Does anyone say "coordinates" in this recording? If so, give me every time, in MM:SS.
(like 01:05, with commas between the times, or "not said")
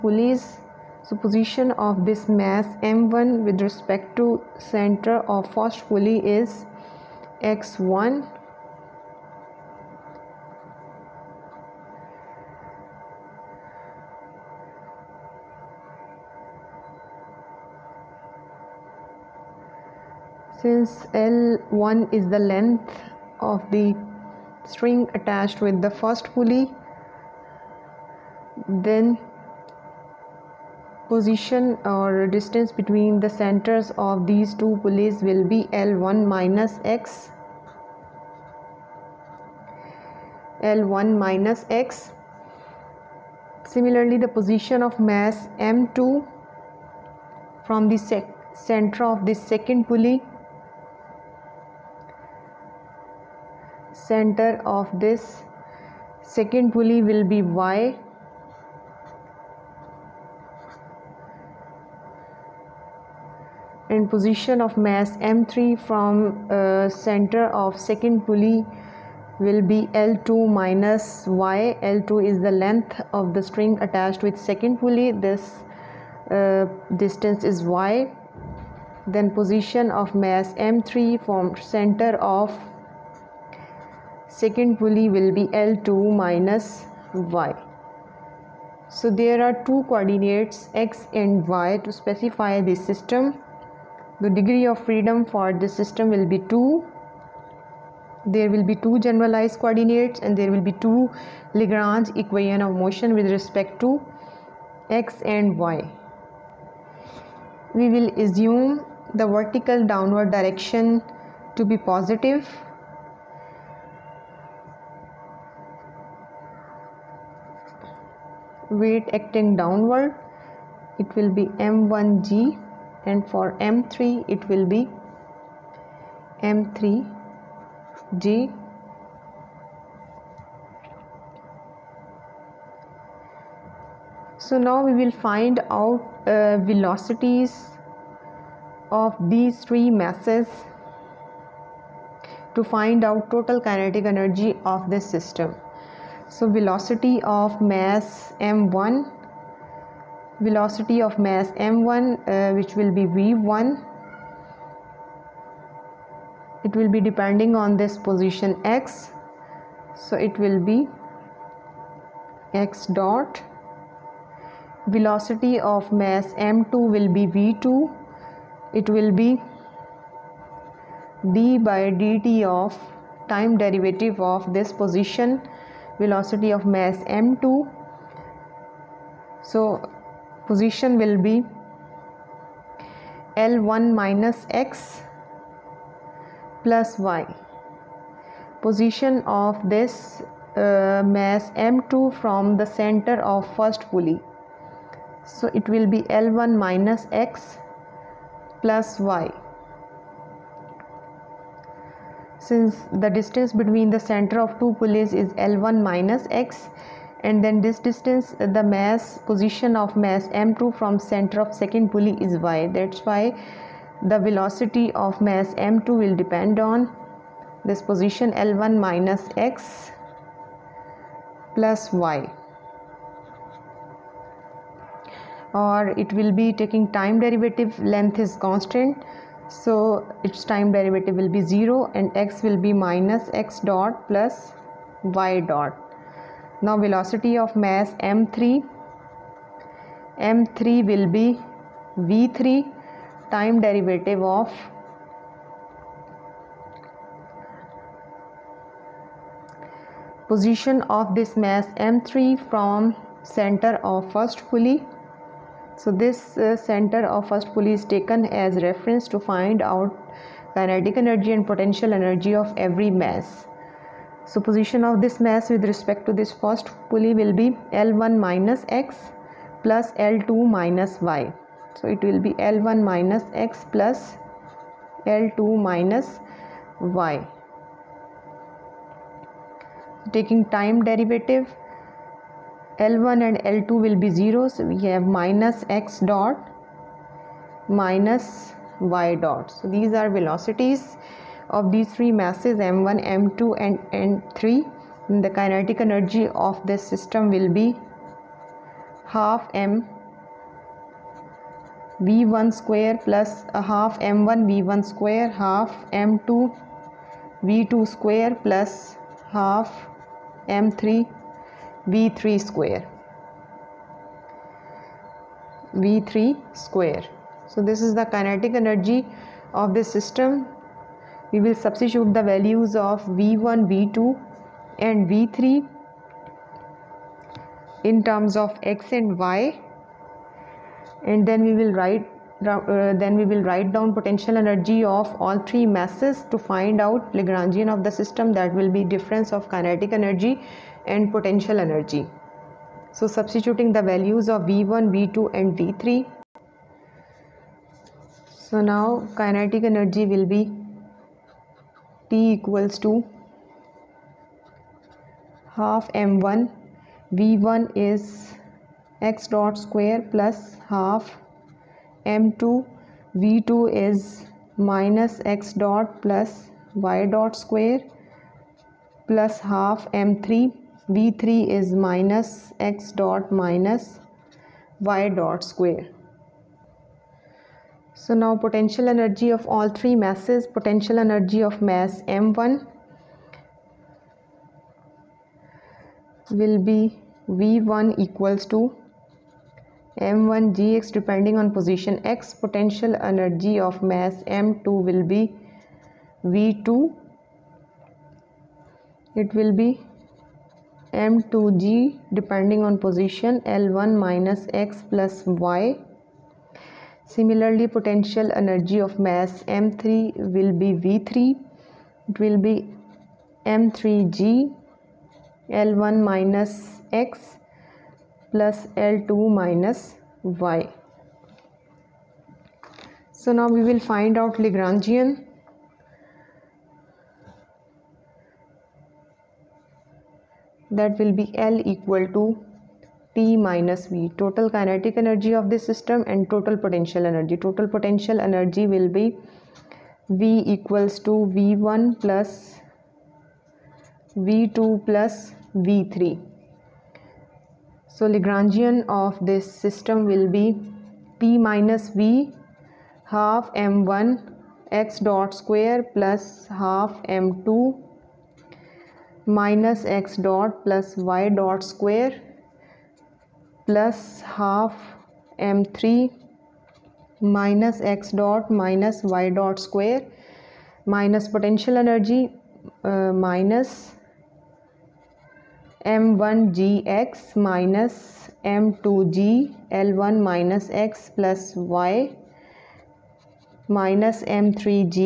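01:29, 01:39.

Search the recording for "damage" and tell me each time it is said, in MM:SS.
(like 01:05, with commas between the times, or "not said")
not said.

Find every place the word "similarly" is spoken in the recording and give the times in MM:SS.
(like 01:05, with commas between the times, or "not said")
00:43, 06:47.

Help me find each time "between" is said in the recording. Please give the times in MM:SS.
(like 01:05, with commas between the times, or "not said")
00:32, 03:23.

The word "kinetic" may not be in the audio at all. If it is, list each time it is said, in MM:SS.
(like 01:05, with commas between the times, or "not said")
02:23, 04:20, 04:55, 05:18, 05:39, 05:49, 07:14.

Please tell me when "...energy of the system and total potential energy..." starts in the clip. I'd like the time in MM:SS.
07:14.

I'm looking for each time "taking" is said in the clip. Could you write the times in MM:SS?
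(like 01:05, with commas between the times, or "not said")
03:46, 04:40.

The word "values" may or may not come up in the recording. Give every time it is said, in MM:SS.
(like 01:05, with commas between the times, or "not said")
05:22, 05:43.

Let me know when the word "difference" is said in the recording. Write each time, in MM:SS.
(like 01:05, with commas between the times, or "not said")
05:38.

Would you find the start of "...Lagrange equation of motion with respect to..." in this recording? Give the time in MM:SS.
01:41.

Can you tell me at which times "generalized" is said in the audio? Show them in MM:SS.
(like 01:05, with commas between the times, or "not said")
01:38.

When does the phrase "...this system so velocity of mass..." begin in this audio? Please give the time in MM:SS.
02:24.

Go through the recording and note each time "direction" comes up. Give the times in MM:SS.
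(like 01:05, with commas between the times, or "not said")
01:50.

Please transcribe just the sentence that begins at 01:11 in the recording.
L2 is the length of the string attached with second pulley.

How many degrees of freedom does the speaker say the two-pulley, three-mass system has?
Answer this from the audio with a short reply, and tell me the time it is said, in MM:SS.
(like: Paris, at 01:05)
2, at 01:34.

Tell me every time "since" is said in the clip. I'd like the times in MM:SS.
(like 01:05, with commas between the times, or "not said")
00:20, 03:22.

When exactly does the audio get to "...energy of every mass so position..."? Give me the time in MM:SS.
04:21.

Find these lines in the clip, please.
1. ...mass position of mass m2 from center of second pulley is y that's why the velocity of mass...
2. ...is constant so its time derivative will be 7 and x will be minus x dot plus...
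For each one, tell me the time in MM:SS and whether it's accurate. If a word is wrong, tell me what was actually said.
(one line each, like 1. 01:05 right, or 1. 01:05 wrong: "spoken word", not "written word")
1. 03:28 right
2. 03:48 wrong: "0", not "7".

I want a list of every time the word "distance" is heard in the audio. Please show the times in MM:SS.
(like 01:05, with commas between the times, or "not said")
00:32, 01:16, 03:23, 03:27.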